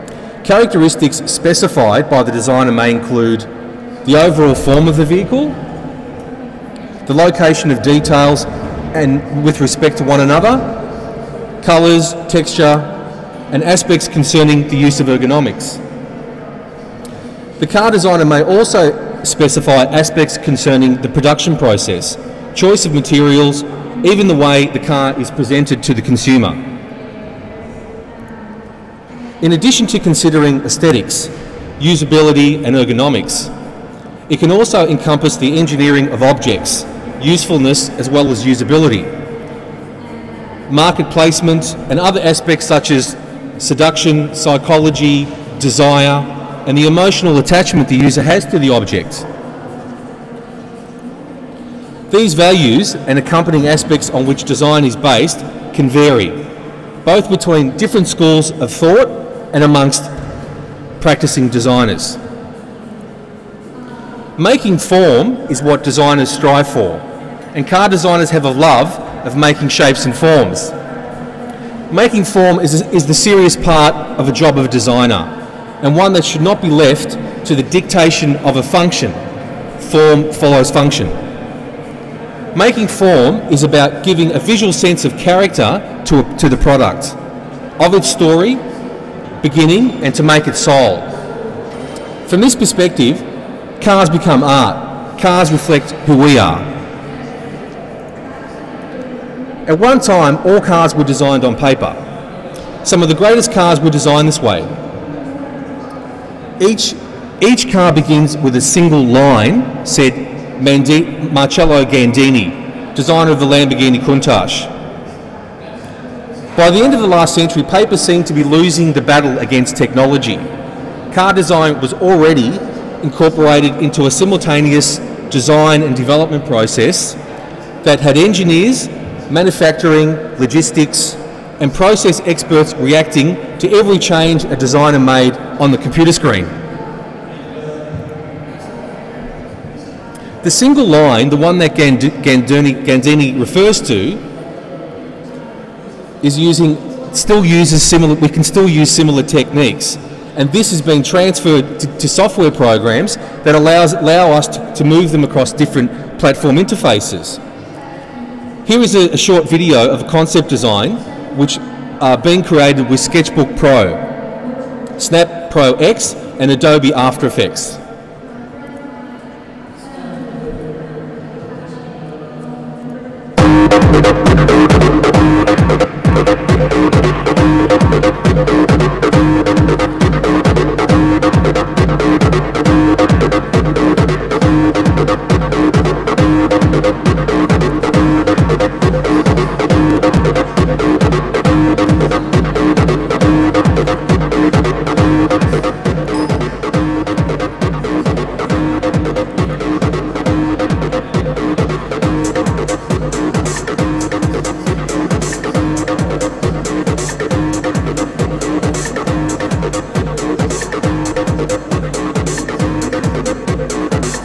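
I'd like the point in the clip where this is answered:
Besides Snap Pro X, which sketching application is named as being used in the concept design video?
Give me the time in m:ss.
2:43.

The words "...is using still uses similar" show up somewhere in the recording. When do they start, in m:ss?
2:26.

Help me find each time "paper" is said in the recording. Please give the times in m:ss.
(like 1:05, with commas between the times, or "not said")
1:41, 1:57.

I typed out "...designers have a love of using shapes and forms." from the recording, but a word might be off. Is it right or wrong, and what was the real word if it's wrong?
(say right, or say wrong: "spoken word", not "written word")
wrong: "making", not "using".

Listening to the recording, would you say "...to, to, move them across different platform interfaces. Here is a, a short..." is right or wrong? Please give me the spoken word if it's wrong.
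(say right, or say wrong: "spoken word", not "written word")
right.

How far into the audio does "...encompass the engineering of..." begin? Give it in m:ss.
0:34.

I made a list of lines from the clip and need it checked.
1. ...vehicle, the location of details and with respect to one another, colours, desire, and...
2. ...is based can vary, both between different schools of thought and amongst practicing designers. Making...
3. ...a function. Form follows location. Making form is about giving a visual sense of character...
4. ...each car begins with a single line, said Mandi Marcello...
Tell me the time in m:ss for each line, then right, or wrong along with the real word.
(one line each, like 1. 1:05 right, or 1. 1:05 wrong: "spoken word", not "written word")
1. 0:05 wrong: "texture", not "desire"
2. 0:54 right
3. 1:18 wrong: "function", not "location"
4. 1:47 right.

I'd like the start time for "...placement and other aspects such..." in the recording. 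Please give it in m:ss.
0:41.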